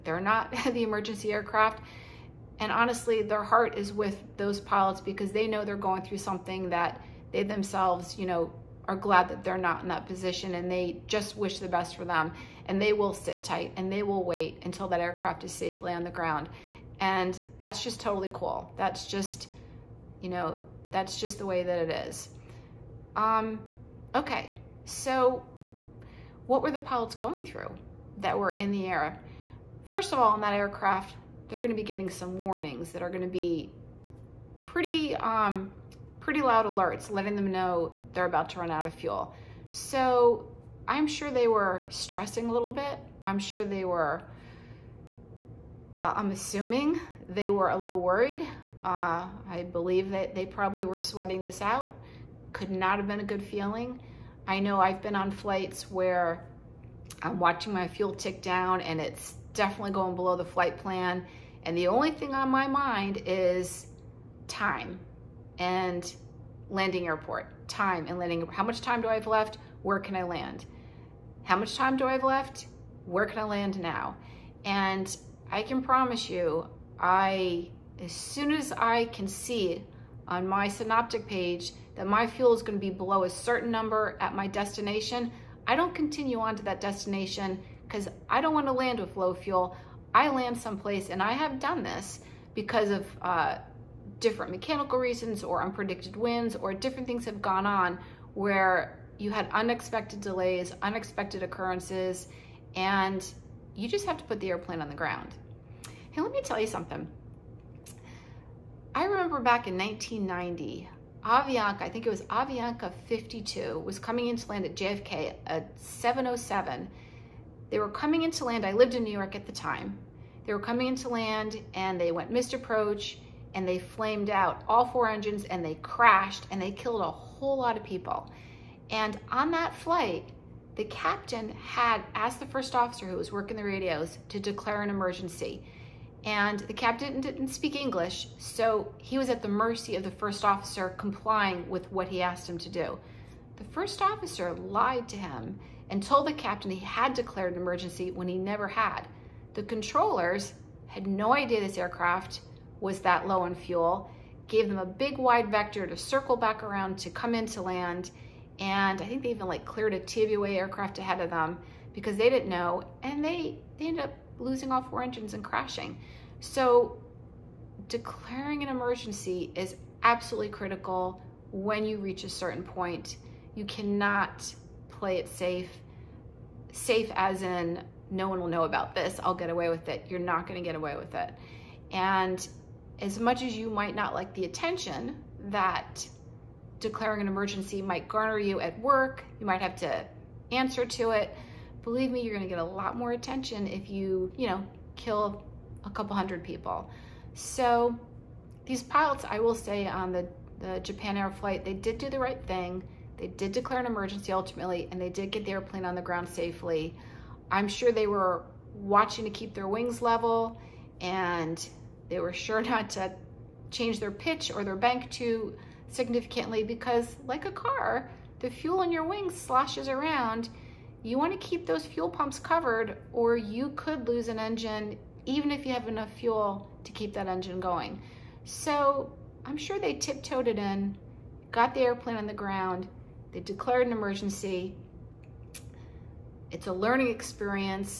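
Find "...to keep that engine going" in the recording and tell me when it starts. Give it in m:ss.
3:46.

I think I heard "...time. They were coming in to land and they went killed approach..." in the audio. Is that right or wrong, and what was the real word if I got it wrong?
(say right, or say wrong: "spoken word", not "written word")
wrong: "missed", not "killed".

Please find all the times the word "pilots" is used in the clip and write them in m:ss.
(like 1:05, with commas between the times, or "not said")
0:04, 0:26, 3:18.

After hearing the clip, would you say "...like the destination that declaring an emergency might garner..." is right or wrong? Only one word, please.
wrong.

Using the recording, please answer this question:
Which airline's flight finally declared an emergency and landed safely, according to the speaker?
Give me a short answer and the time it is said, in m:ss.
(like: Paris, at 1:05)
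Japan Air, at 3:20.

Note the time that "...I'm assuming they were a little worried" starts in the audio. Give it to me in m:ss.
0:46.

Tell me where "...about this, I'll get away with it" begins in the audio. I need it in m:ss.
2:58.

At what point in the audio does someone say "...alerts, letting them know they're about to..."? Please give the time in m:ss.
0:36.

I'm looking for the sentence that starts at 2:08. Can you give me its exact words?
And on that flight, the captain had asked the first officer who was working the radios to declare an emergency.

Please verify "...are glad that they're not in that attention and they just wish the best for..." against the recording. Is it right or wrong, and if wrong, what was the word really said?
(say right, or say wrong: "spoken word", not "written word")
wrong: "position", not "attention".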